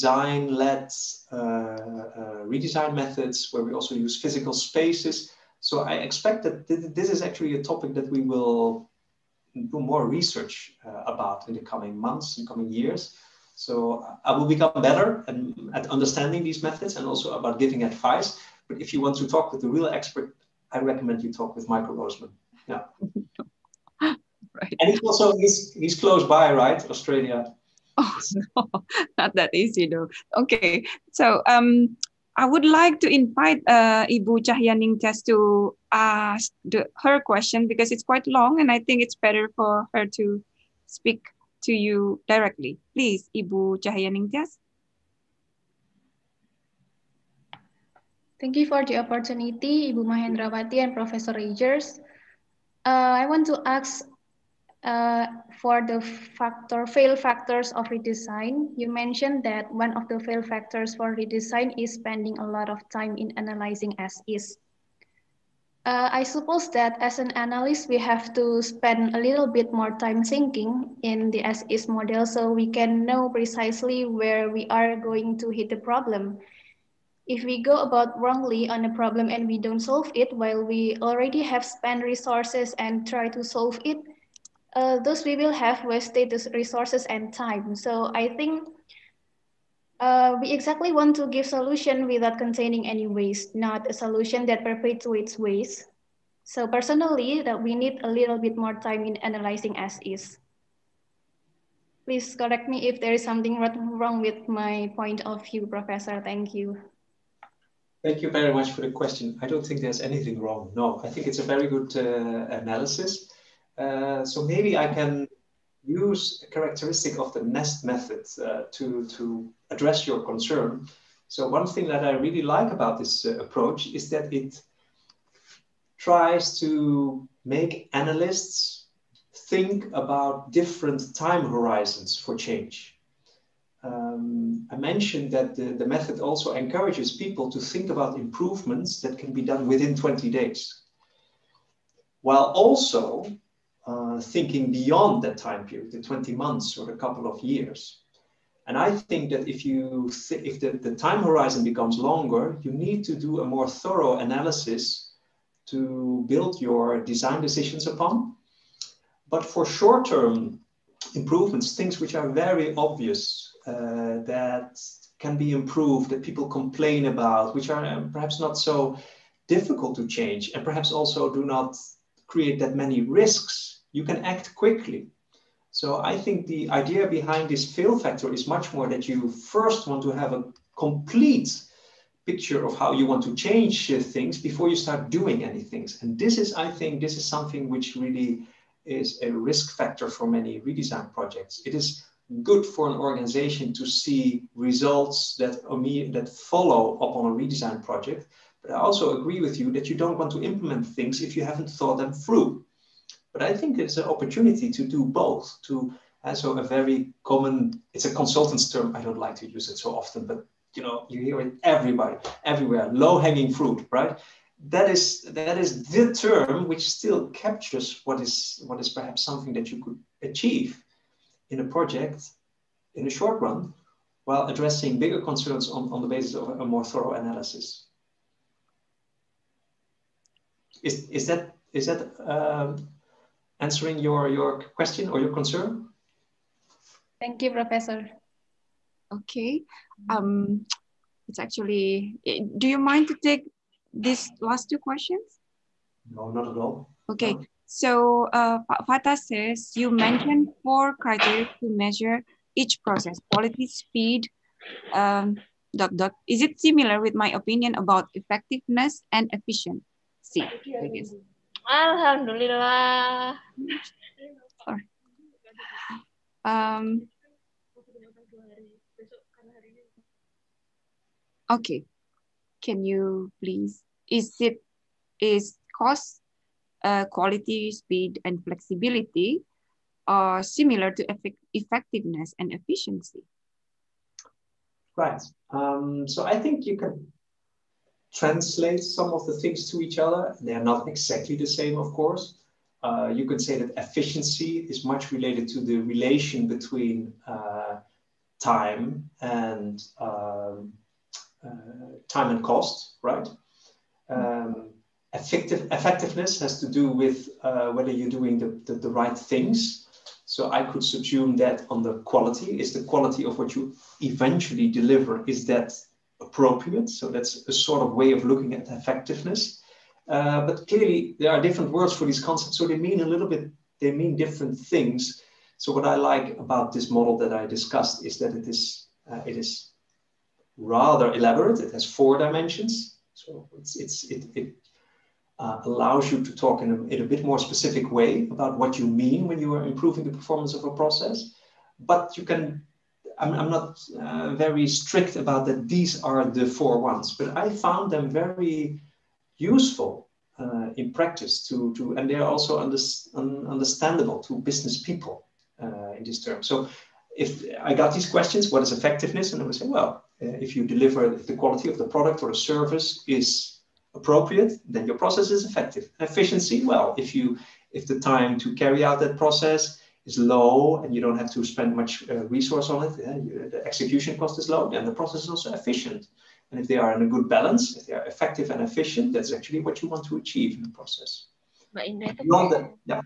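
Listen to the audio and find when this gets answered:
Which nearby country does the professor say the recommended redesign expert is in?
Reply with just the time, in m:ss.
0:26.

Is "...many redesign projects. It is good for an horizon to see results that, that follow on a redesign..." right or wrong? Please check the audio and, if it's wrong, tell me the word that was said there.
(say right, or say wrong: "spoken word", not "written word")
wrong: "organization", not "horizon".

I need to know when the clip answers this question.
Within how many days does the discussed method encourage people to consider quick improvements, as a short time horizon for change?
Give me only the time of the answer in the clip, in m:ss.
2:19.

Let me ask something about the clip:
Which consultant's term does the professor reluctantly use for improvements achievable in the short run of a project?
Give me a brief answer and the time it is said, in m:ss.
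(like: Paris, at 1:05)
Low hanging fruit, at 3:32.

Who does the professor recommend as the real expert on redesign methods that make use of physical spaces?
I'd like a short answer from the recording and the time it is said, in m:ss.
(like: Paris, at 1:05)
Michael Rosemann, at 0:21.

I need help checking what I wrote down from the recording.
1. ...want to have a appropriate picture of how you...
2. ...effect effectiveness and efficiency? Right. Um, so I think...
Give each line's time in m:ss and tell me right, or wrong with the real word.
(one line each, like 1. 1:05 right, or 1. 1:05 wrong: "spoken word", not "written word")
1. 2:59 wrong: "complete", not "appropriate"
2. 4:41 right.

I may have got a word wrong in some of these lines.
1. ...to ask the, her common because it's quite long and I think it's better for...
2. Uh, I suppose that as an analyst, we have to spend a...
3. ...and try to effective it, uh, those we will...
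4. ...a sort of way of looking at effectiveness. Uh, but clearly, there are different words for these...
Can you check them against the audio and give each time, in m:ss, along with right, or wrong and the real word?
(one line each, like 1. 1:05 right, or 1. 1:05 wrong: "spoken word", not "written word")
1. 0:35 wrong: "question", not "common"
2. 1:05 right
3. 1:22 wrong: "solve", not "effective"
4. 5:17 right.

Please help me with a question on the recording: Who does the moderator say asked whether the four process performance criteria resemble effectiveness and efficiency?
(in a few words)
Fata.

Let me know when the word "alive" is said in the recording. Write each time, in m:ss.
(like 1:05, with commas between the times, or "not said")
not said.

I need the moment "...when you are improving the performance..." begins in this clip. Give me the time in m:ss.
5:39.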